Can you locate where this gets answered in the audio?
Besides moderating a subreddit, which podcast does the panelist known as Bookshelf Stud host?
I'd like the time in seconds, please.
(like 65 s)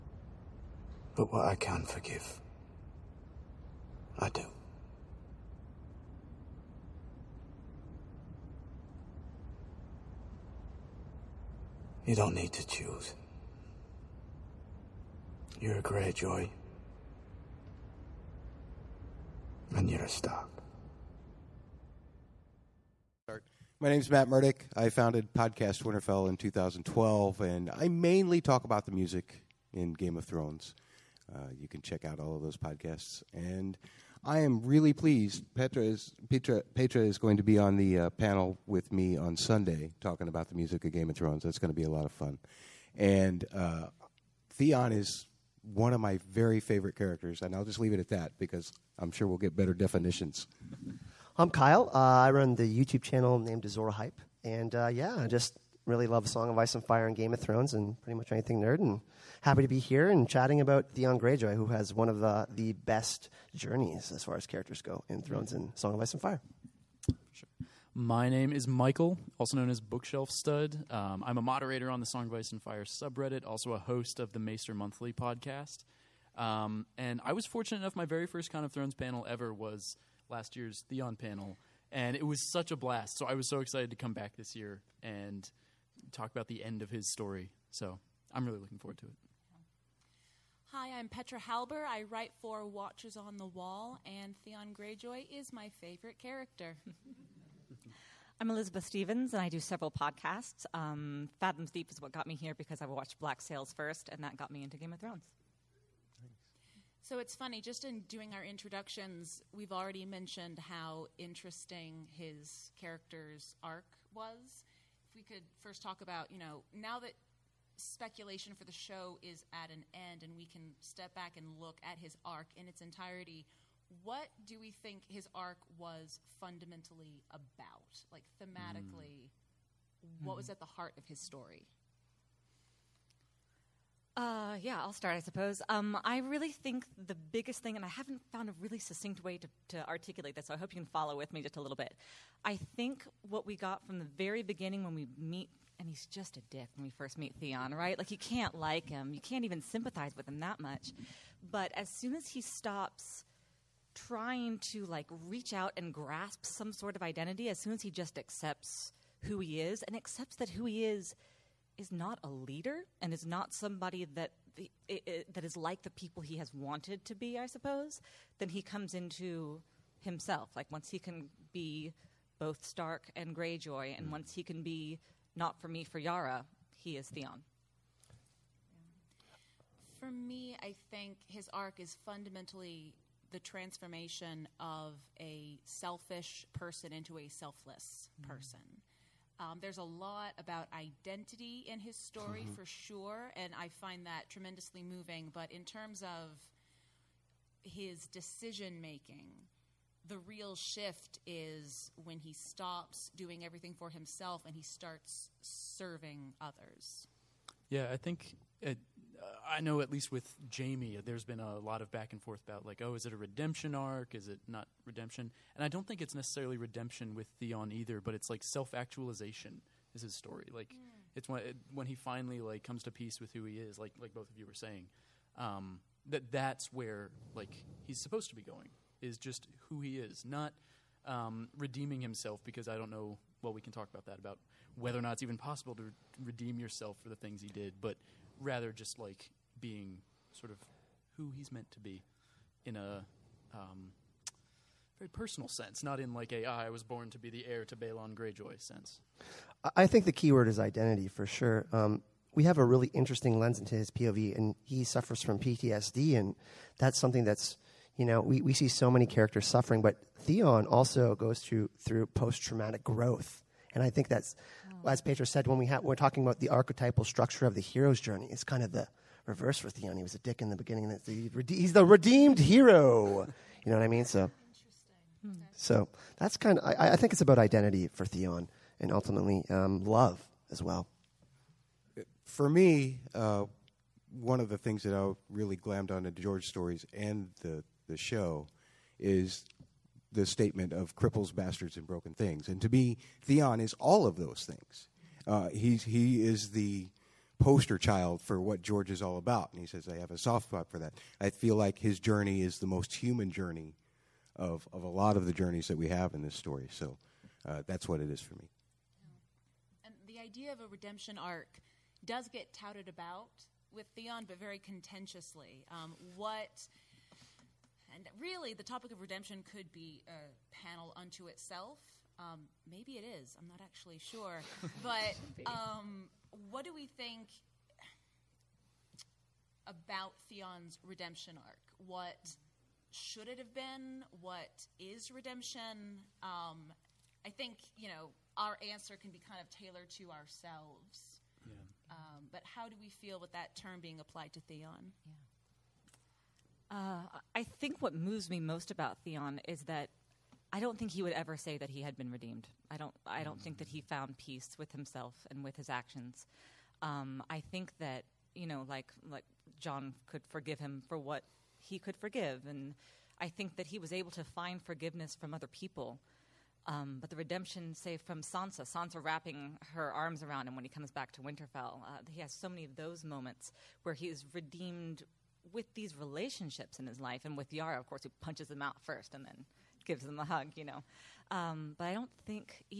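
74 s.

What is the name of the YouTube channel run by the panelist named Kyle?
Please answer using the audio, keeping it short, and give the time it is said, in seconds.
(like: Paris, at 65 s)
Azora Hype, at 53 s.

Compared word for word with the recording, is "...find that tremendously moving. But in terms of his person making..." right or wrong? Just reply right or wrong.
wrong.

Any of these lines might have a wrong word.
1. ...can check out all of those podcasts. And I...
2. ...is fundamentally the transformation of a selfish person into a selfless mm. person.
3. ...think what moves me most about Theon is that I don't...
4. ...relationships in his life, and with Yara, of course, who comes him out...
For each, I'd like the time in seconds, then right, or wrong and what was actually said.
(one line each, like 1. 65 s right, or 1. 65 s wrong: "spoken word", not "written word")
1. 31 s right
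2. 181 s right
3. 347 s right
4. 375 s wrong: "punches", not "comes".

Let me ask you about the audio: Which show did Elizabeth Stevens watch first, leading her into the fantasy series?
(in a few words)
Black Sails.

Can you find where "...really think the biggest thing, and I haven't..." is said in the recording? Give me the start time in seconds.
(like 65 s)
136 s.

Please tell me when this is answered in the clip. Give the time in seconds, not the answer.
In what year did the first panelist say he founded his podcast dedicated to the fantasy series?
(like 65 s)
26 s.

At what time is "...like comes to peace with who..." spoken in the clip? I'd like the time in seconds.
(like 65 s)
222 s.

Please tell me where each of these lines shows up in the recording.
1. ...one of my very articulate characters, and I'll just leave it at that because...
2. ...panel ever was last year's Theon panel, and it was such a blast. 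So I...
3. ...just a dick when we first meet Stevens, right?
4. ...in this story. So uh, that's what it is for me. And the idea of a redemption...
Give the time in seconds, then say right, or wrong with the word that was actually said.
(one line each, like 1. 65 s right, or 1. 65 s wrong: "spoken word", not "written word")
1. 45 s wrong: "favorite", not "articulate"
2. 78 s right
3. 146 s wrong: "Theon", not "Stevens"
4. 306 s right.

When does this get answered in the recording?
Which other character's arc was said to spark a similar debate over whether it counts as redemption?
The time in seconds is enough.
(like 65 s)
210 s.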